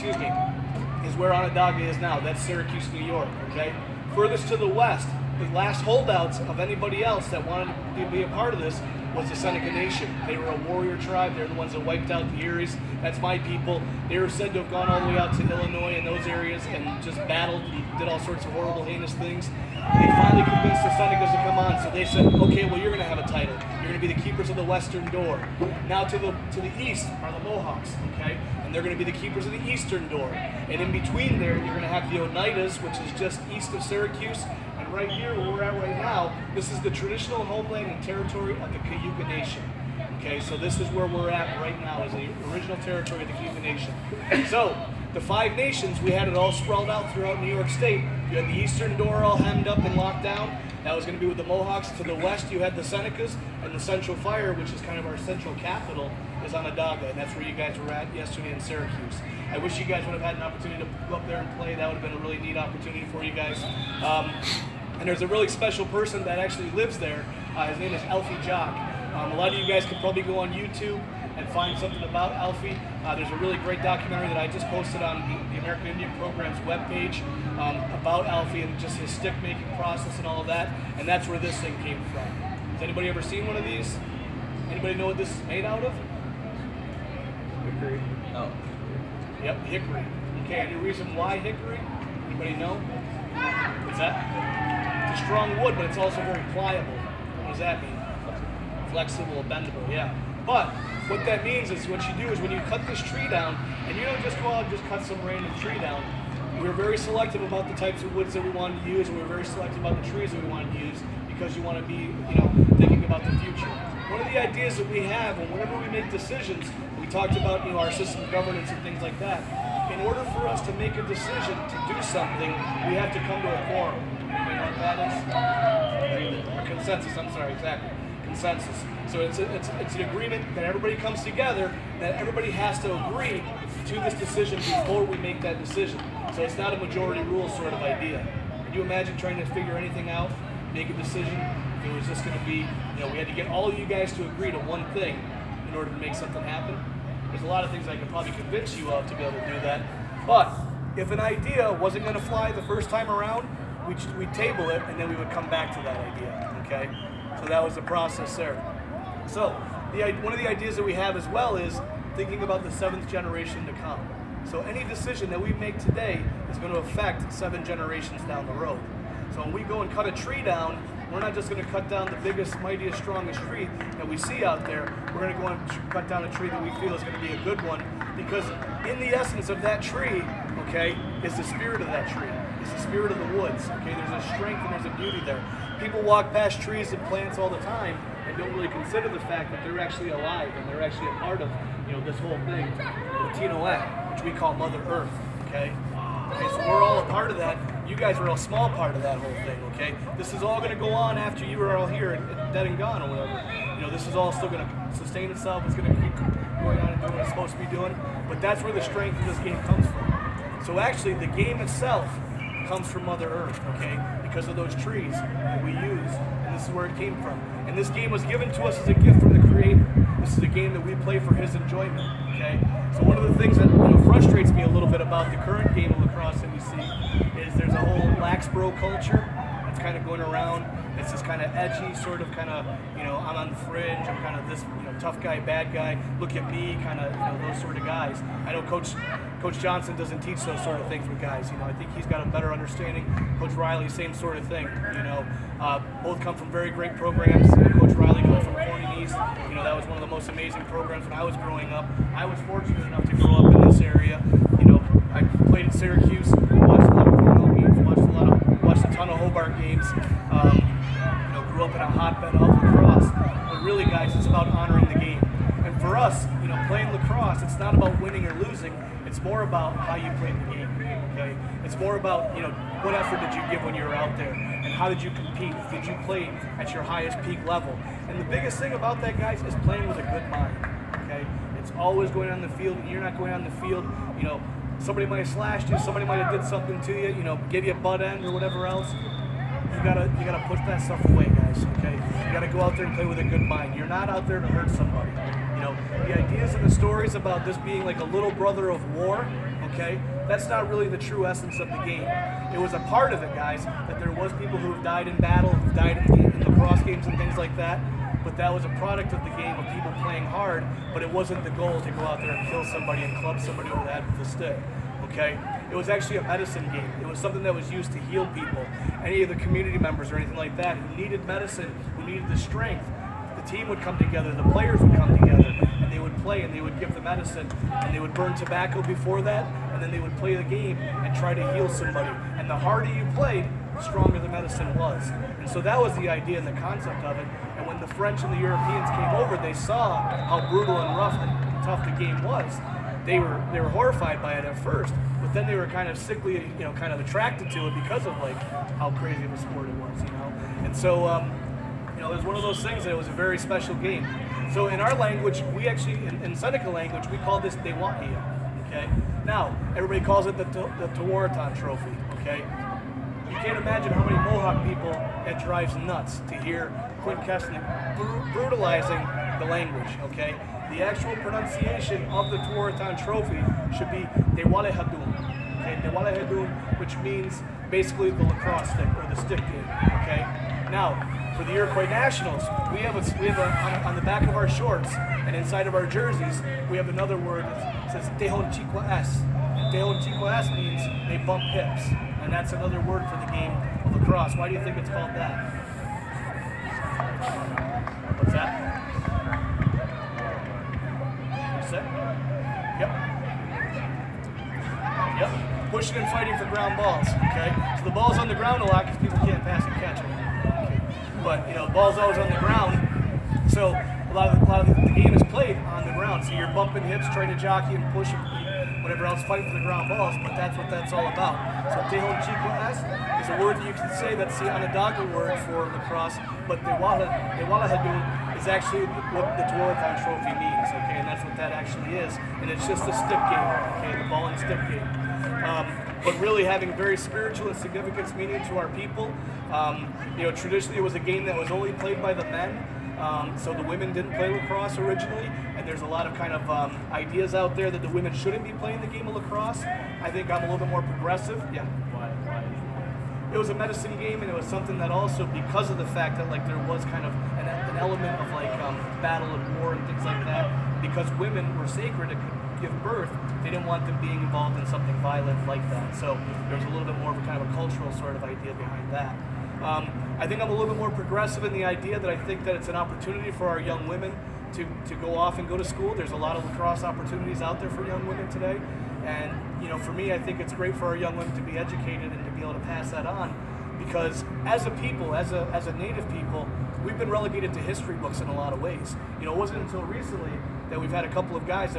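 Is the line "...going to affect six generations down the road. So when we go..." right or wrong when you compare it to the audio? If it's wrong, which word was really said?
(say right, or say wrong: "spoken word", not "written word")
wrong: "seven", not "six".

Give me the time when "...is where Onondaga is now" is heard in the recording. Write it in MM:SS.
00:01.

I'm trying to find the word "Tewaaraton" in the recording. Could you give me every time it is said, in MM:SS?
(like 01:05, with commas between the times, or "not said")
06:00, 06:12, 07:09.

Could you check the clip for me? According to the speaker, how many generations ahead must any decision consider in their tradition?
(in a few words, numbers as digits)
7.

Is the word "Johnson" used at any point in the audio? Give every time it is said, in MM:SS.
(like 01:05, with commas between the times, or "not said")
03:59.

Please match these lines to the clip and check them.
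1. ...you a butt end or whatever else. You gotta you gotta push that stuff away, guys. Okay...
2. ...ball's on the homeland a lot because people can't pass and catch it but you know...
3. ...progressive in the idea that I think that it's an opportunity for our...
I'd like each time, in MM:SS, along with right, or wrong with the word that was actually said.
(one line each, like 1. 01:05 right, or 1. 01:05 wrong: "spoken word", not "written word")
1. 04:47 right
2. 06:47 wrong: "ground", not "homeland"
3. 07:50 right.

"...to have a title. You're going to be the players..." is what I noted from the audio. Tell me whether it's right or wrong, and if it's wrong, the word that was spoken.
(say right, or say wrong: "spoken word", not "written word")
wrong: "keepers", not "players".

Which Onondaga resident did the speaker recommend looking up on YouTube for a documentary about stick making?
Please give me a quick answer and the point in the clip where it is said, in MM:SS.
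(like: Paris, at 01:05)
Alfie Jacques, at 01:08.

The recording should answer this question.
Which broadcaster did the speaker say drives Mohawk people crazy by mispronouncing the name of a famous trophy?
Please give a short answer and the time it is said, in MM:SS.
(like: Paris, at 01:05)
Quint Kessenich, at 06:07.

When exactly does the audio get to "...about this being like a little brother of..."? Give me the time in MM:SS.
04:57.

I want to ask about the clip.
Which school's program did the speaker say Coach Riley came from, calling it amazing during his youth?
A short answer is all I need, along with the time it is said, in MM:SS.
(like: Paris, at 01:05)
Corning East, at 04:08.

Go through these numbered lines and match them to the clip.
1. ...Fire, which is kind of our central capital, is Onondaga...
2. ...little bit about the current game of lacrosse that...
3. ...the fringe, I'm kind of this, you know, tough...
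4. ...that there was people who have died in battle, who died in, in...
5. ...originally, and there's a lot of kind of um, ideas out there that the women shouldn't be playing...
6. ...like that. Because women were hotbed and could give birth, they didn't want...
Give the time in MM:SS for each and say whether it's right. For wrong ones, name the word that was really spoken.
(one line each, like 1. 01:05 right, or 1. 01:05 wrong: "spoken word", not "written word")
1. 00:54 right
2. 03:44 right
3. 03:53 right
4. 05:03 right
5. 07:24 right
6. 07:40 wrong: "sacred", not "hotbed".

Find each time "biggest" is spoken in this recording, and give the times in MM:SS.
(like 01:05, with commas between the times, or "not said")
02:52, 04:38.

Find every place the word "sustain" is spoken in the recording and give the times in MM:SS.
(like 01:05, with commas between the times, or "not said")
03:24.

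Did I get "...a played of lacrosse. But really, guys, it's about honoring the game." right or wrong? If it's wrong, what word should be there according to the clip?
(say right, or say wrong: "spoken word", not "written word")
wrong: "hotbed", not "played".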